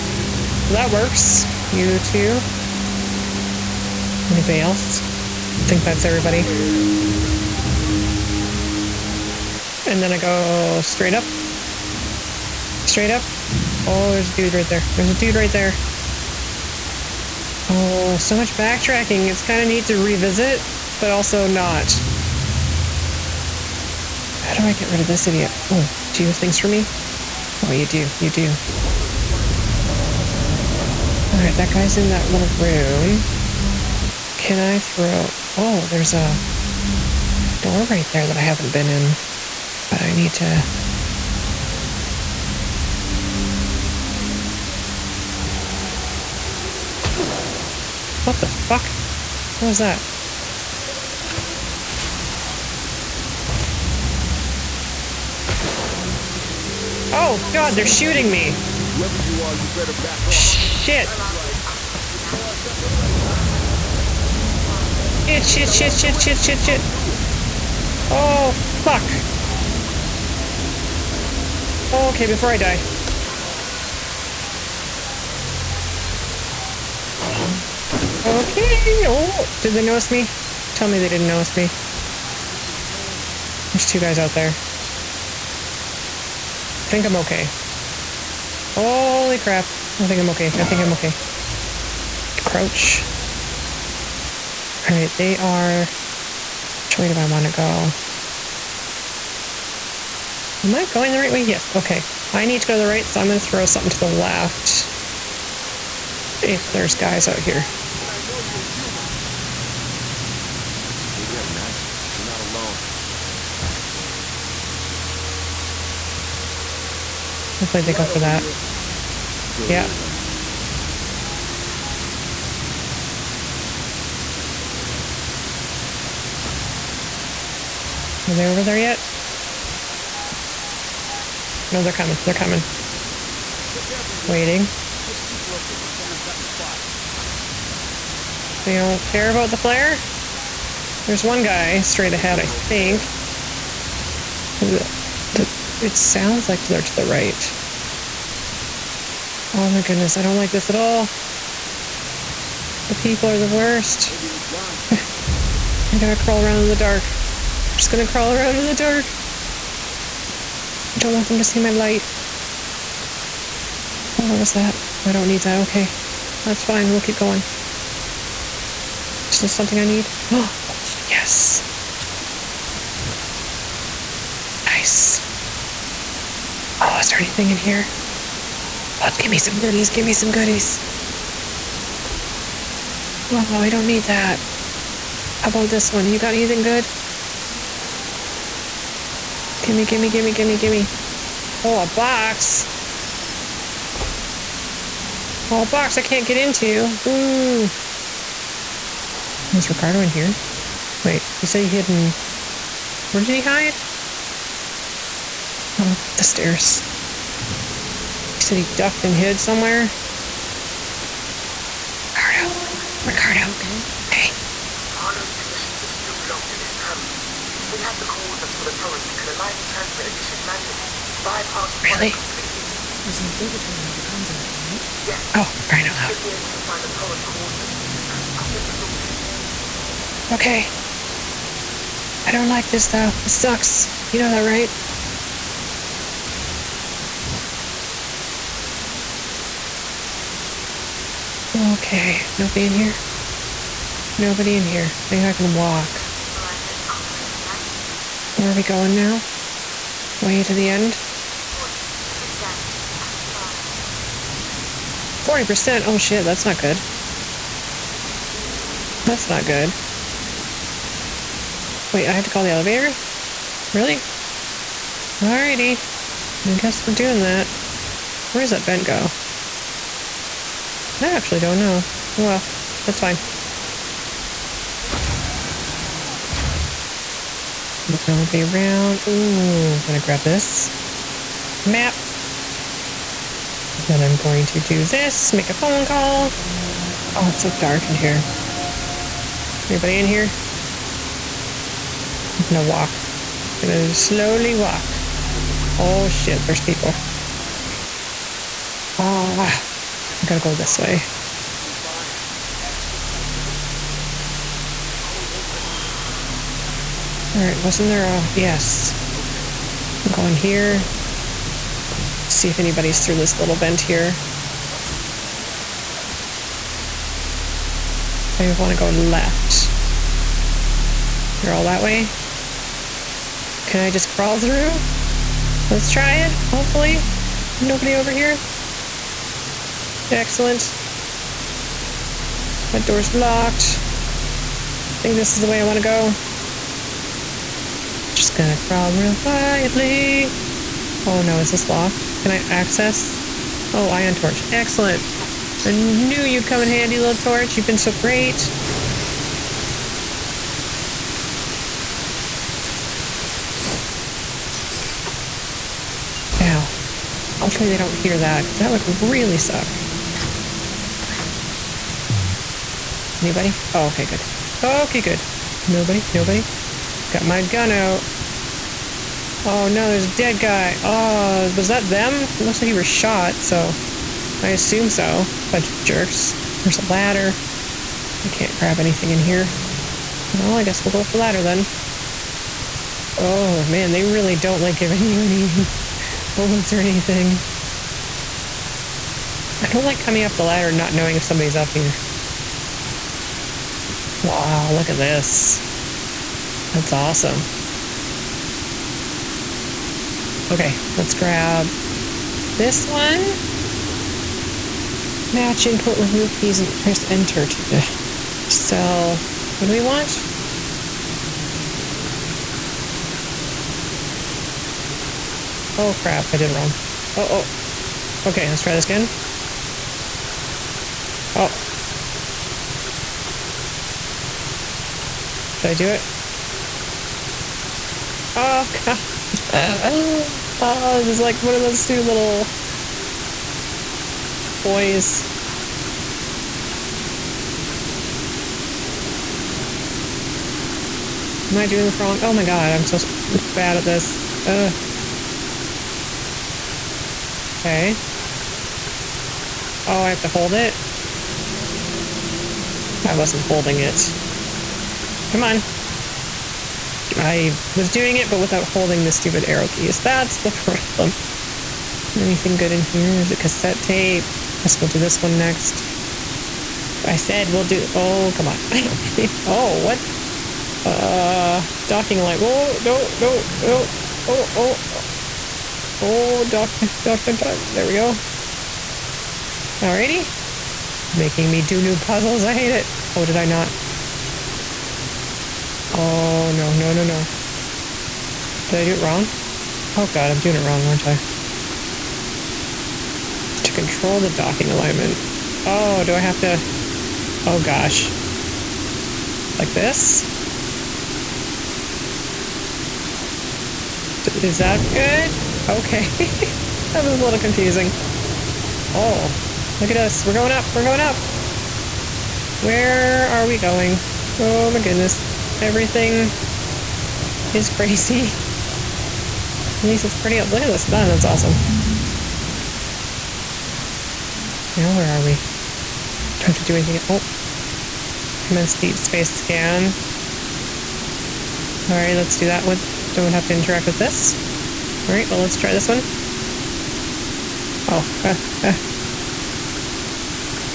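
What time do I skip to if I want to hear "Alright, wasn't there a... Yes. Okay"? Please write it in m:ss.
5:07.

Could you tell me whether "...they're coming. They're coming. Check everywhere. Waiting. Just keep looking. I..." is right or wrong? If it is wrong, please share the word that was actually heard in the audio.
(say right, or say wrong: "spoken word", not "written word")
right.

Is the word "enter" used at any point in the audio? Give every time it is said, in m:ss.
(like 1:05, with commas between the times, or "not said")
6:47.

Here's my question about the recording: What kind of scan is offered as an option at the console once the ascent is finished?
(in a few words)
deep space scan.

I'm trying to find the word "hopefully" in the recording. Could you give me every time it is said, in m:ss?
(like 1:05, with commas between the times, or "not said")
1:57, 5:26, 5:57.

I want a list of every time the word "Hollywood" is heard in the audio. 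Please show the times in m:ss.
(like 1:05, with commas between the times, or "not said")
not said.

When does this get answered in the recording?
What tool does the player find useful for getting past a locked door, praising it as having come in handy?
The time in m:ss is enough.
5:43.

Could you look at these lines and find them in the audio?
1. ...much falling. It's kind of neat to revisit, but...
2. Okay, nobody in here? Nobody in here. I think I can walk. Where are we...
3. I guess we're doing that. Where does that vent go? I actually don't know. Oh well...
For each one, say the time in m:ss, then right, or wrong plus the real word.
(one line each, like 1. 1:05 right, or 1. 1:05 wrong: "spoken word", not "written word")
1. 0:18 wrong: "backtracking", not "falling"
2. 4:01 right
3. 4:26 right.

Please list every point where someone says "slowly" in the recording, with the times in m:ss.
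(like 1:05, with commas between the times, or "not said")
4:53.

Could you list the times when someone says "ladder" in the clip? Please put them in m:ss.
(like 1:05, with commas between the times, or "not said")
6:16, 6:21, 6:30.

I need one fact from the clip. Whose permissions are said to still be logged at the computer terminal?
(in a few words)
Marlow.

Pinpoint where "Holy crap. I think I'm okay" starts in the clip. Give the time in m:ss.
1:28.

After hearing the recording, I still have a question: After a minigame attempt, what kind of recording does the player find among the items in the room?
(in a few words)
cassette tape.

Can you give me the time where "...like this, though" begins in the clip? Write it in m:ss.
3:52.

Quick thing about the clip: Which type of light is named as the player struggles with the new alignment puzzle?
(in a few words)
docking light.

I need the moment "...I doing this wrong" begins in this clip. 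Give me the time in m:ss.
7:21.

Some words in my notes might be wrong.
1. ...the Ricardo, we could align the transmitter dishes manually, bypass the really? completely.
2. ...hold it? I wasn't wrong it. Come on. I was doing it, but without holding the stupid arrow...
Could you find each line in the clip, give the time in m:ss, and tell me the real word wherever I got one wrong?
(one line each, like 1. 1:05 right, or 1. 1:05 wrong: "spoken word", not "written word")
1. 3:38 wrong: "Torrens", not "Ricardo"
2. 7:30 wrong: "holding", not "wrong".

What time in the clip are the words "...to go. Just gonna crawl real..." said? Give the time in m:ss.
5:35.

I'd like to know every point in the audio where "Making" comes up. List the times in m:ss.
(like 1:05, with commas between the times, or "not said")
8:01.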